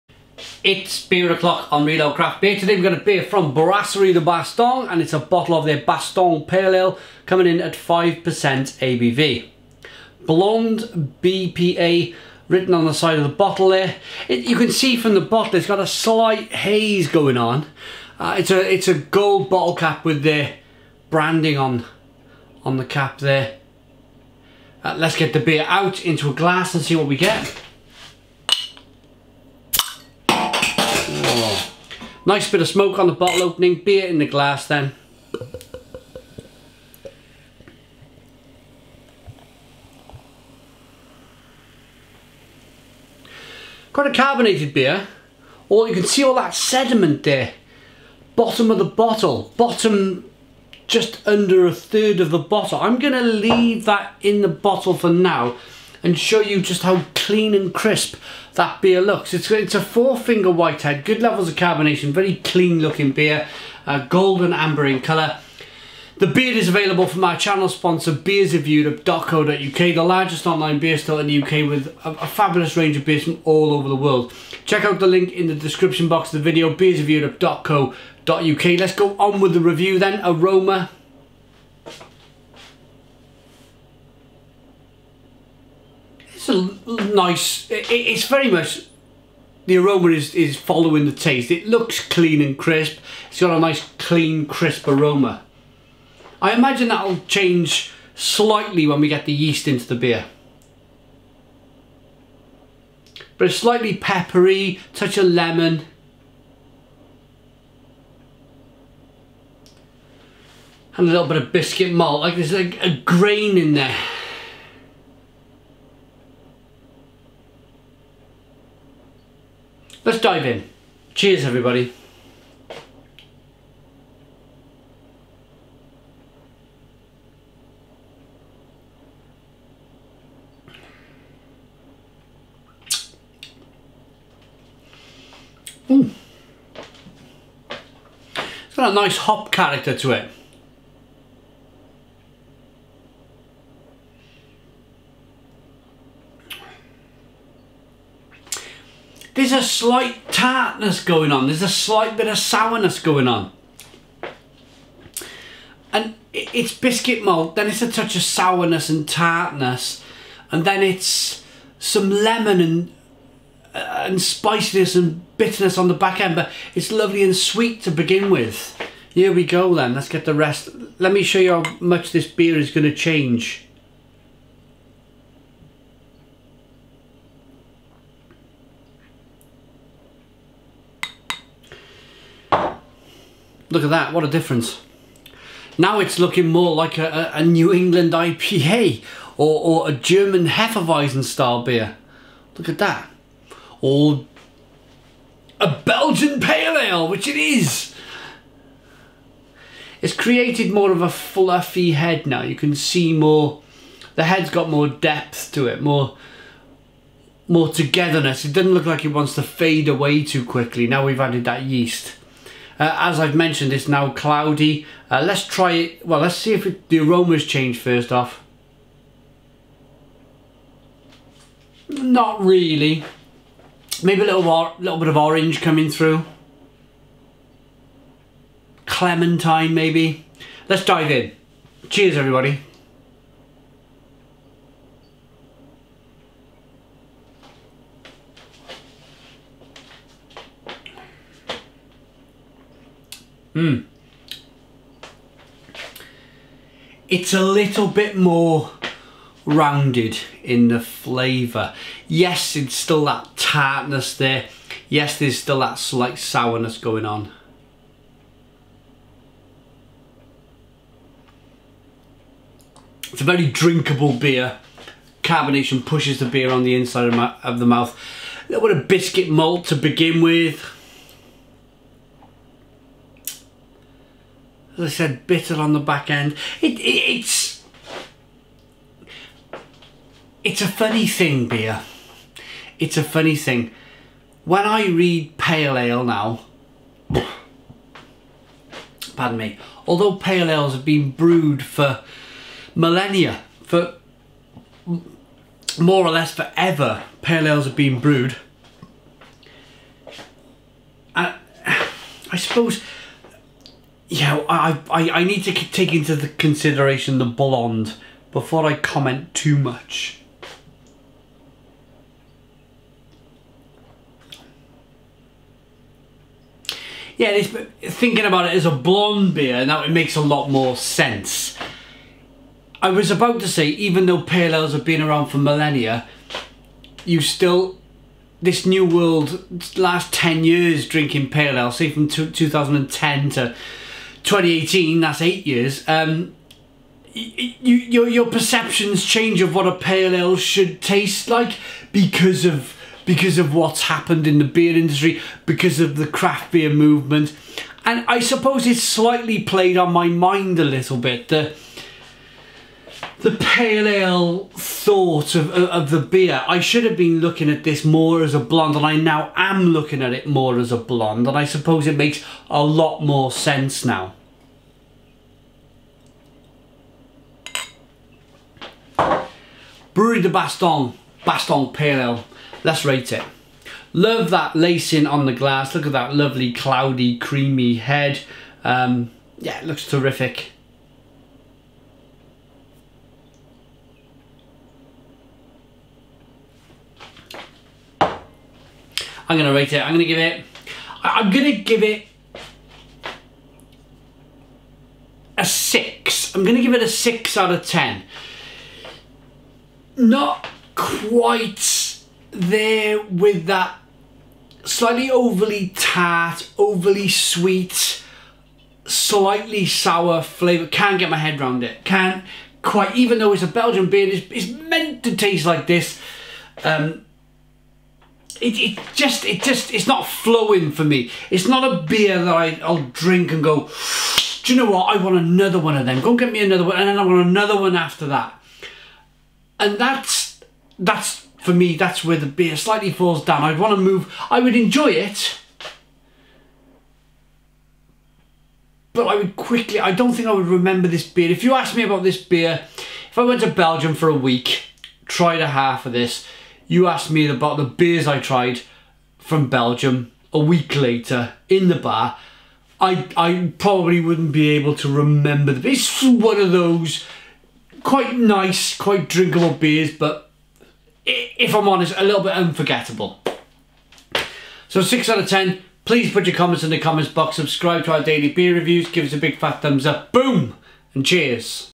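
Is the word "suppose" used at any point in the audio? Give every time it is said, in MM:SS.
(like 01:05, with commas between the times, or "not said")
05:02, 05:48, 06:01.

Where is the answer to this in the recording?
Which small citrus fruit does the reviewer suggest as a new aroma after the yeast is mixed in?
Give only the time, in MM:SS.
03:48.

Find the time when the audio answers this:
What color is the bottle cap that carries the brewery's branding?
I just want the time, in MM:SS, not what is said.
00:18.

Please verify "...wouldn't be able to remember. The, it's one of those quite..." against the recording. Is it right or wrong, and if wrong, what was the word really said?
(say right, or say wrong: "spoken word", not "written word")
right.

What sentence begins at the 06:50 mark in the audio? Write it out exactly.
Can't get my head around it.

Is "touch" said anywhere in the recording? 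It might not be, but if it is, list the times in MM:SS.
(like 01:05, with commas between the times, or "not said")
01:44, 02:37.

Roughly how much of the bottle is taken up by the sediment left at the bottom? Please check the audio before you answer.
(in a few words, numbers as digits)
Just under a third.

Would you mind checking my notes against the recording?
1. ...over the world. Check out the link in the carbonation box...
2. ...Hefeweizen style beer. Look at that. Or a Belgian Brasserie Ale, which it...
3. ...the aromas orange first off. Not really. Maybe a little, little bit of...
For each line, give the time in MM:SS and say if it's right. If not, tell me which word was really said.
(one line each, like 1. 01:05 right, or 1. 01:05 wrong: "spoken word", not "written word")
1. 01:13 wrong: "description", not "carbonation"
2. 03:10 wrong: "Pale", not "Brasserie"
3. 03:36 wrong: "change", not "orange".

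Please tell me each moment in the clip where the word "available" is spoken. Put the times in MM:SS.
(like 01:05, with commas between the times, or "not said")
01:06.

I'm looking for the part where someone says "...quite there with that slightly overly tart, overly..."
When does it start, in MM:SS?
06:40.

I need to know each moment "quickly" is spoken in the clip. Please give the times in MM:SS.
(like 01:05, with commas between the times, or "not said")
03:30, 07:19.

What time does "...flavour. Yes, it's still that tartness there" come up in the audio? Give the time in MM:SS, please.
04:10.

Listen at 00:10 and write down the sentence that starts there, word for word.
Blonde BPA written on the side of the bottle there.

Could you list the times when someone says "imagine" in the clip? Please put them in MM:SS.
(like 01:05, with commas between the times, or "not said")
01:36.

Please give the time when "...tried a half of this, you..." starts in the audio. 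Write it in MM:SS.
07:25.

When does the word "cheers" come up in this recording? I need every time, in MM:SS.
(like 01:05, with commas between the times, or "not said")
02:01, 03:51, 07:51.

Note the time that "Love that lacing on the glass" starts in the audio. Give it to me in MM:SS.
06:13.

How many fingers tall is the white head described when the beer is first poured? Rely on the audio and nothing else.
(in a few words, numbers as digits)
4.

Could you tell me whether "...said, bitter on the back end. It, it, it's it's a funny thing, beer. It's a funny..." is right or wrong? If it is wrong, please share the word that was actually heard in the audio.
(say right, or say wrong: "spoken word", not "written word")
right.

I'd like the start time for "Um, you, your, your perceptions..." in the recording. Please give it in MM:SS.
05:35.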